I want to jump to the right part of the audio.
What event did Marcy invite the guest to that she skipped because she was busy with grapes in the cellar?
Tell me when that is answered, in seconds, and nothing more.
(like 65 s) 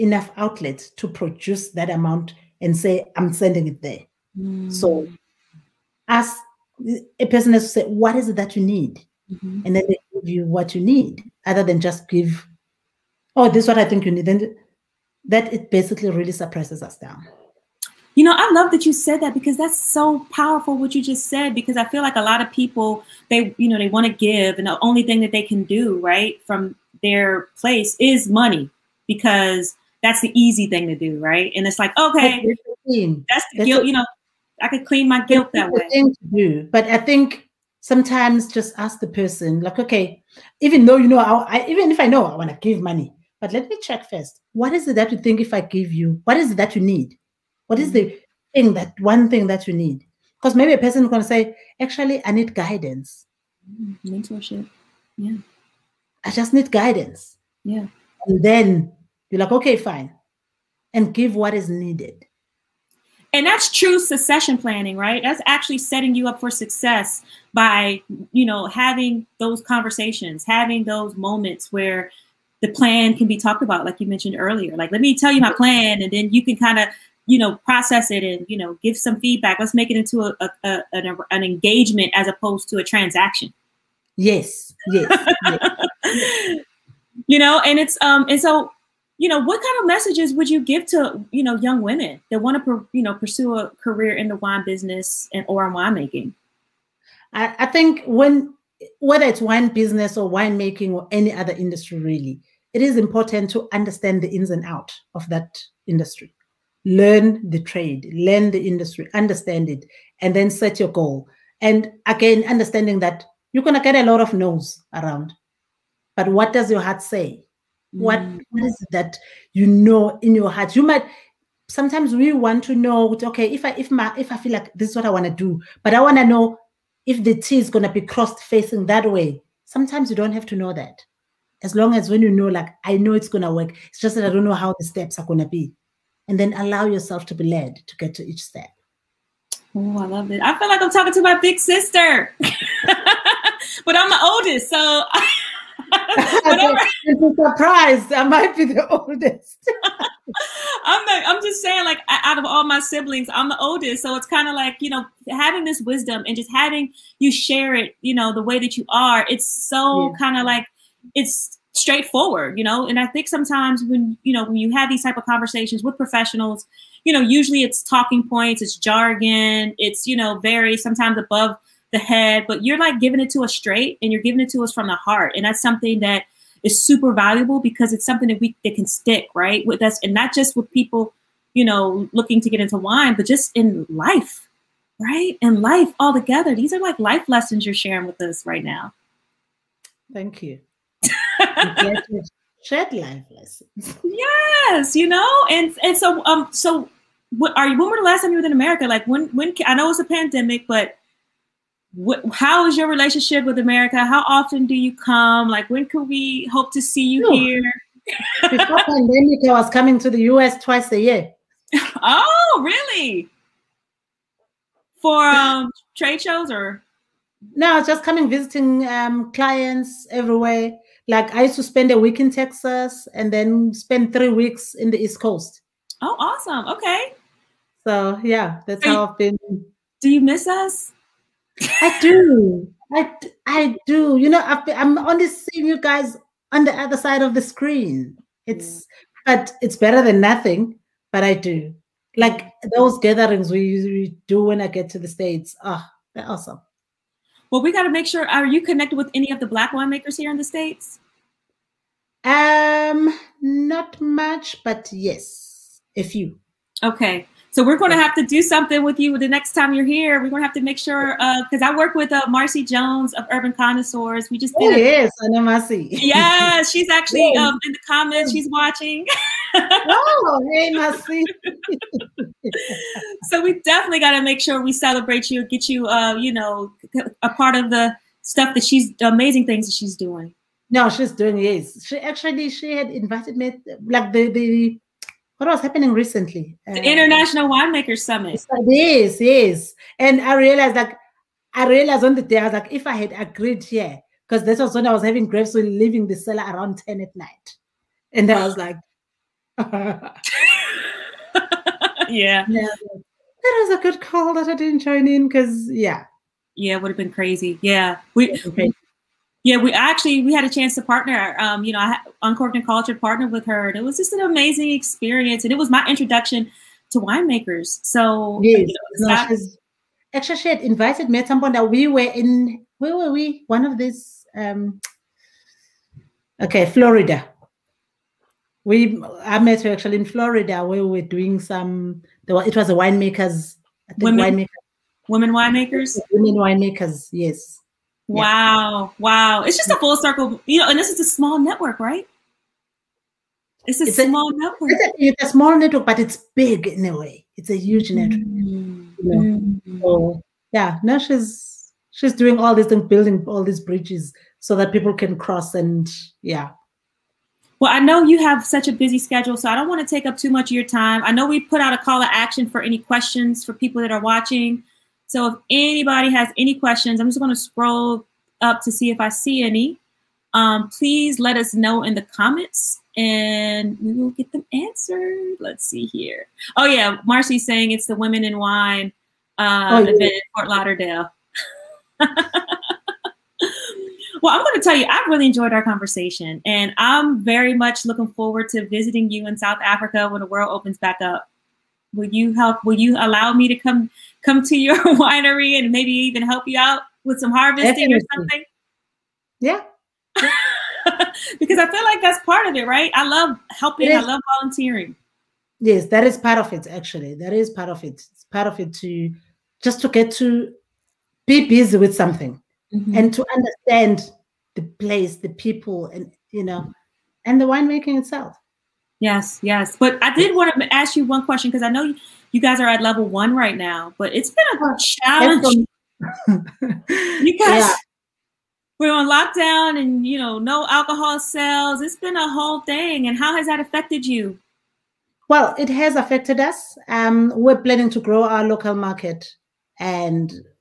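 286 s.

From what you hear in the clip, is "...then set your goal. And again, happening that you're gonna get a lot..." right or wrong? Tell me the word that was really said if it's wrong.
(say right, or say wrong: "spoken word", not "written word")
wrong: "understanding", not "happening".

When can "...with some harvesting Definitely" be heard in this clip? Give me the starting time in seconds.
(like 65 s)
397 s.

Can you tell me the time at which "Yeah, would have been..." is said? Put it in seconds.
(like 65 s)
306 s.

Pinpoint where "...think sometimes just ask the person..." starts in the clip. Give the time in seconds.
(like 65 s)
36 s.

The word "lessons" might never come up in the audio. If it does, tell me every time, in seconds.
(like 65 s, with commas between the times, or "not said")
187 s, 193 s.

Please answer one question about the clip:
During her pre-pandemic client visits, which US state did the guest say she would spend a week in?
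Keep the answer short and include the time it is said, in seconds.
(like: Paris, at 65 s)
Texas, at 222 s.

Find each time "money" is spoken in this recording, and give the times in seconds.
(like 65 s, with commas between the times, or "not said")
28 s, 42 s.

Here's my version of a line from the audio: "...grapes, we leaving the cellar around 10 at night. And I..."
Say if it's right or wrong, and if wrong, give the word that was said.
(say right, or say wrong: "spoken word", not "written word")
right.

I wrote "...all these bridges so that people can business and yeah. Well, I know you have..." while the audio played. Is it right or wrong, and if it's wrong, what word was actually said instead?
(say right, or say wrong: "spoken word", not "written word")
wrong: "cross", not "business".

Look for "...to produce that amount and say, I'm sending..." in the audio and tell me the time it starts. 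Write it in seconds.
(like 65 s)
0 s.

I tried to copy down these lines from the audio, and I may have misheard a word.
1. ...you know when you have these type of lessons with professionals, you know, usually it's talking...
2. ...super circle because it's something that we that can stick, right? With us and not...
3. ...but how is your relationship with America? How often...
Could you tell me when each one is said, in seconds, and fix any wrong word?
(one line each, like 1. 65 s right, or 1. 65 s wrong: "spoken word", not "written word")
1. 164 s wrong: "conversations", not "lessons"
2. 176 s wrong: "valuable", not "circle"
3. 200 s right.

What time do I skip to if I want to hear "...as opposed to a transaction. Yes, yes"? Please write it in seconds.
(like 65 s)
82 s.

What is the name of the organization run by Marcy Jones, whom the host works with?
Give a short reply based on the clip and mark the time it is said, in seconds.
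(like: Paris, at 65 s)
Urban Connoisseurs, at 263 s.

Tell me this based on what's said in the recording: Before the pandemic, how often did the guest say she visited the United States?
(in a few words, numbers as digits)
twice a year.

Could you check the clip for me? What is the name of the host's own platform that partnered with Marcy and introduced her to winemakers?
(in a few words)
Uncorked and Cultured.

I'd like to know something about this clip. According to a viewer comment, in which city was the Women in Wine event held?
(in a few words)
Fort Lauderdale.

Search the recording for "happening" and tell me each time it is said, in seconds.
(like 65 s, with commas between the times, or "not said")
285 s.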